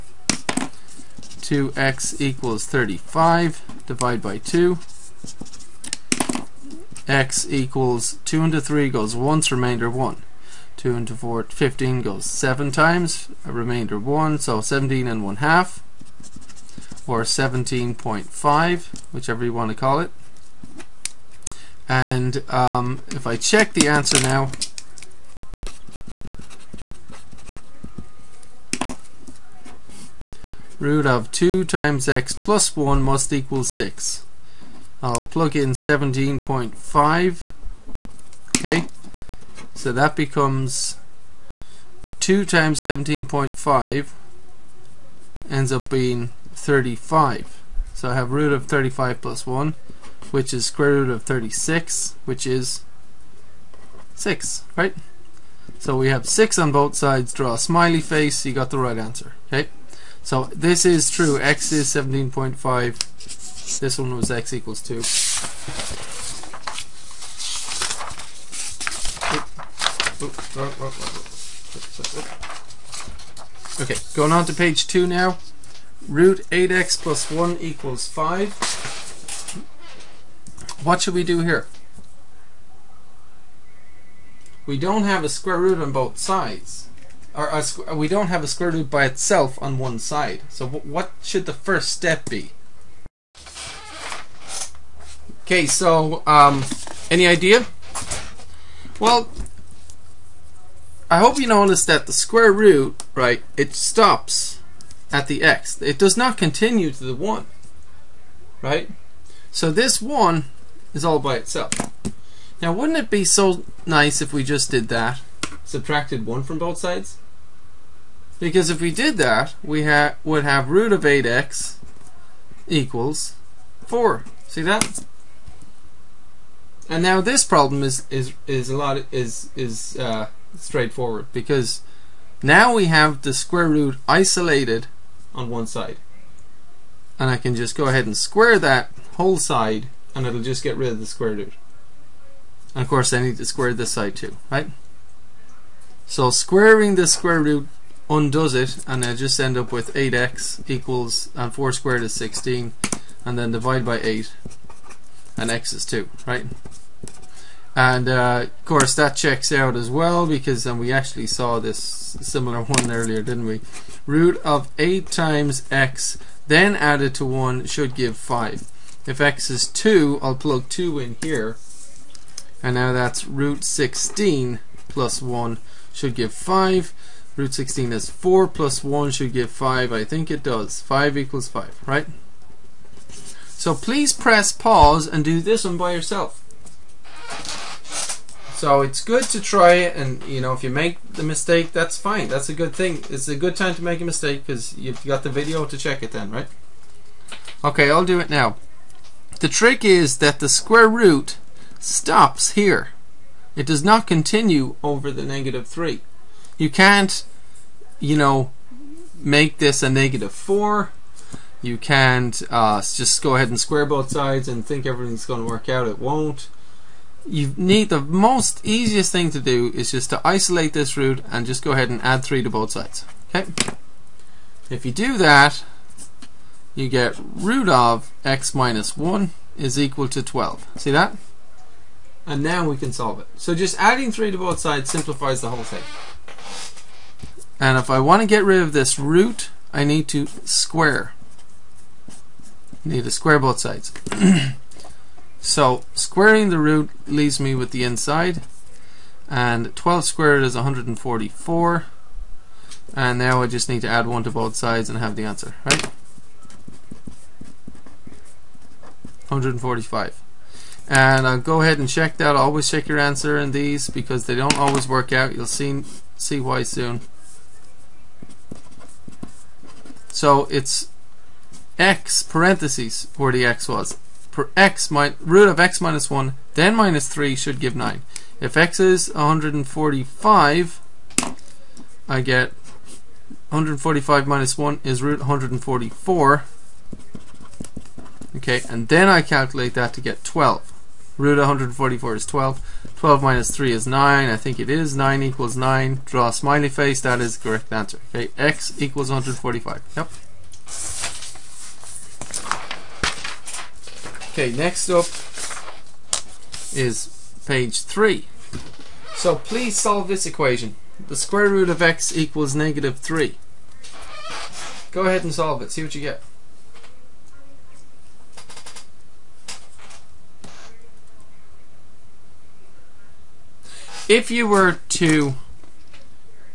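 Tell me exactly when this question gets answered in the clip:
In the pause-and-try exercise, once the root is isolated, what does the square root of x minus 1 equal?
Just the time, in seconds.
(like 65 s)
229 s.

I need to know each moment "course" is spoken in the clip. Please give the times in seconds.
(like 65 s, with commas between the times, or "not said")
142 s, 158 s.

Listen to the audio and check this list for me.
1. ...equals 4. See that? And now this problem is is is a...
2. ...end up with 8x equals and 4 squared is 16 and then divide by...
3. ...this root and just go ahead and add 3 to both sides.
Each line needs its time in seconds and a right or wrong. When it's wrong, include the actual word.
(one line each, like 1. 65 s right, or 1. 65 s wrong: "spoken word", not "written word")
1. 122 s right
2. 149 s right
3. 220 s right.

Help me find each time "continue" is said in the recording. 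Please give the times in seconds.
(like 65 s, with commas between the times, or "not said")
106 s, 204 s.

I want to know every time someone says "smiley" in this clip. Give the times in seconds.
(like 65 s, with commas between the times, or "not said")
57 s, 296 s.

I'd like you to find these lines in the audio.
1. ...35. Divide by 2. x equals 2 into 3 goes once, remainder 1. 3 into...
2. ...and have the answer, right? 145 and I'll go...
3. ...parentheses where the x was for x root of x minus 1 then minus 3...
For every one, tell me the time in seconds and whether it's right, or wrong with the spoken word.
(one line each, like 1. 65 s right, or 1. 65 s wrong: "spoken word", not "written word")
1. 2 s wrong: "2", not "3"
2. 254 s right
3. 272 s right.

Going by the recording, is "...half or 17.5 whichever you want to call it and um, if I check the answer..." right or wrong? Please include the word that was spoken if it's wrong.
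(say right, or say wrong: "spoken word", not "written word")
right.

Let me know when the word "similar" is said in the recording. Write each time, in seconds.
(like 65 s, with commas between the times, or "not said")
162 s.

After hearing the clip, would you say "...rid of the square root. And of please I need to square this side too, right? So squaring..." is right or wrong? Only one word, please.
wrong.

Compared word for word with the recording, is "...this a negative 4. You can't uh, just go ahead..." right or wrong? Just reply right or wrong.
right.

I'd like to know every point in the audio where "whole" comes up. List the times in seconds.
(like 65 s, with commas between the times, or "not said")
139 s, 235 s.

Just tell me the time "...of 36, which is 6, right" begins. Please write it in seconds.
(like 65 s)
51 s.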